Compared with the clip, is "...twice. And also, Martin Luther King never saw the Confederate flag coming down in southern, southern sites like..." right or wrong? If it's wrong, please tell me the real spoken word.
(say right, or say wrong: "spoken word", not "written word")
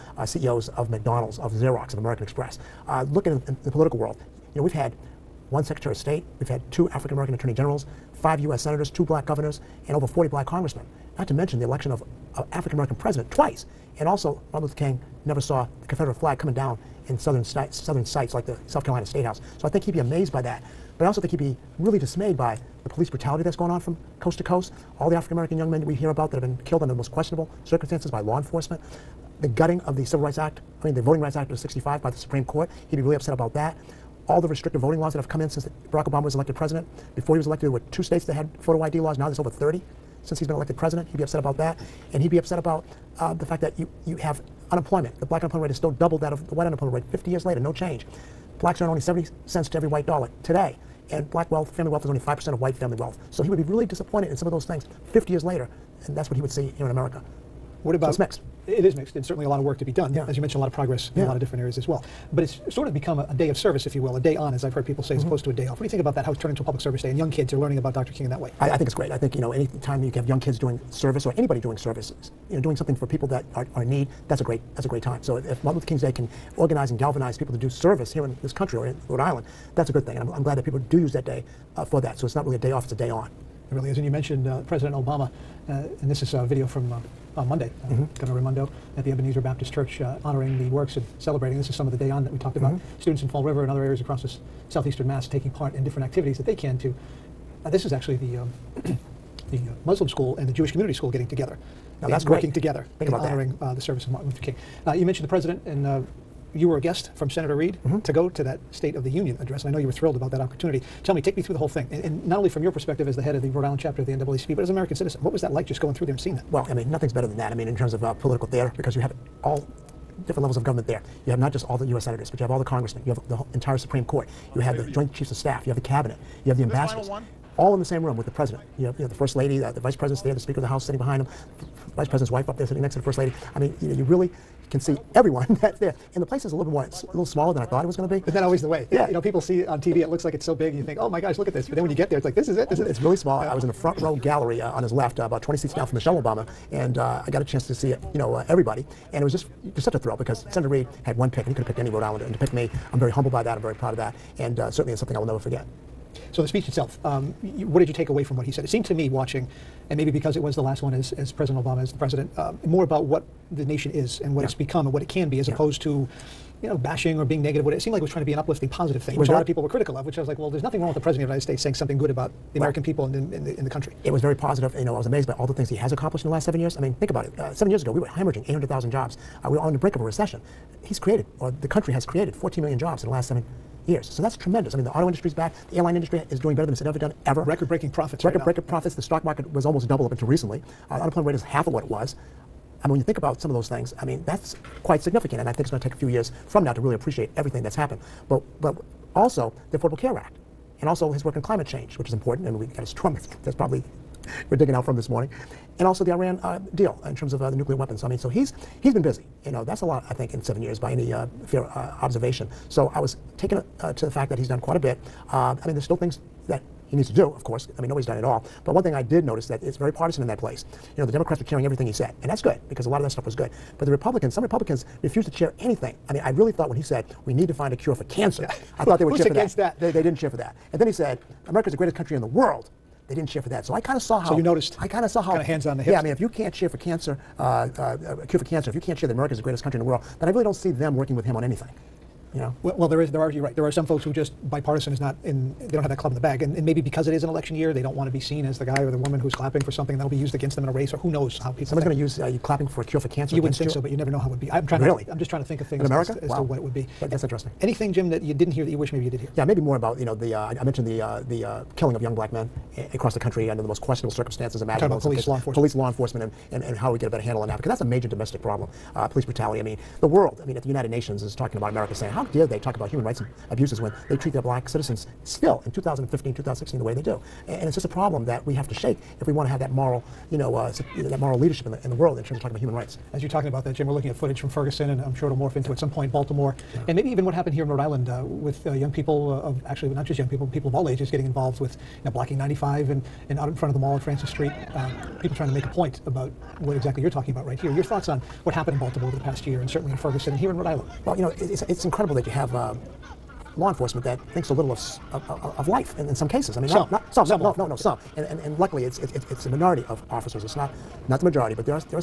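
right.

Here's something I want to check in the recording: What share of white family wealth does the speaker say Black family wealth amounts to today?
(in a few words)
5%.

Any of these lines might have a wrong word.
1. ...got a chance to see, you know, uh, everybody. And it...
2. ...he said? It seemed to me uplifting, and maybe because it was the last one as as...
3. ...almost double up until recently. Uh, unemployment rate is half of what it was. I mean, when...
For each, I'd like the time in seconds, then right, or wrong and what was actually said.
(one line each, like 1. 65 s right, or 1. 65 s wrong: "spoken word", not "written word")
1. 147 s right
2. 158 s wrong: "watching", not "uplifting"
3. 189 s right.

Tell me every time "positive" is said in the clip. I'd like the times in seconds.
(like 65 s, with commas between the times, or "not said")
168 s, 174 s.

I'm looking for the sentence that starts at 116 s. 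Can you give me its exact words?
Well, I mean, nothing's better than that.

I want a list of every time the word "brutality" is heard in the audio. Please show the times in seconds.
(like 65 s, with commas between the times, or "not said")
23 s, 269 s.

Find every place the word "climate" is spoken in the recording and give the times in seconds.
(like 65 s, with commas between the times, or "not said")
201 s.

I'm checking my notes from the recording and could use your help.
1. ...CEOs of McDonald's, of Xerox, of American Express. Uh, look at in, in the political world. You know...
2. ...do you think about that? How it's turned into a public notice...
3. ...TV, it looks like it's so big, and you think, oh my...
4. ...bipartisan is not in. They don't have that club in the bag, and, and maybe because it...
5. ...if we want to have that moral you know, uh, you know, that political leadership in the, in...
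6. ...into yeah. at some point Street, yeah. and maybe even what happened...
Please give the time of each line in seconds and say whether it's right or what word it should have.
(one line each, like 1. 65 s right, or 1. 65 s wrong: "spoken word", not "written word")
1. 0 s right
2. 65 s wrong: "service", not "notice"
3. 139 s right
4. 244 s right
5. 279 s wrong: "moral", not "political"
6. 285 s wrong: "Baltimore", not "Street".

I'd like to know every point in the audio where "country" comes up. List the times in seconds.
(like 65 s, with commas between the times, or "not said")
78 s, 173 s, 181 s, 231 s, 239 s, 263 s.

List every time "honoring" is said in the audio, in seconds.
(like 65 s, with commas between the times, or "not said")
90 s, 103 s.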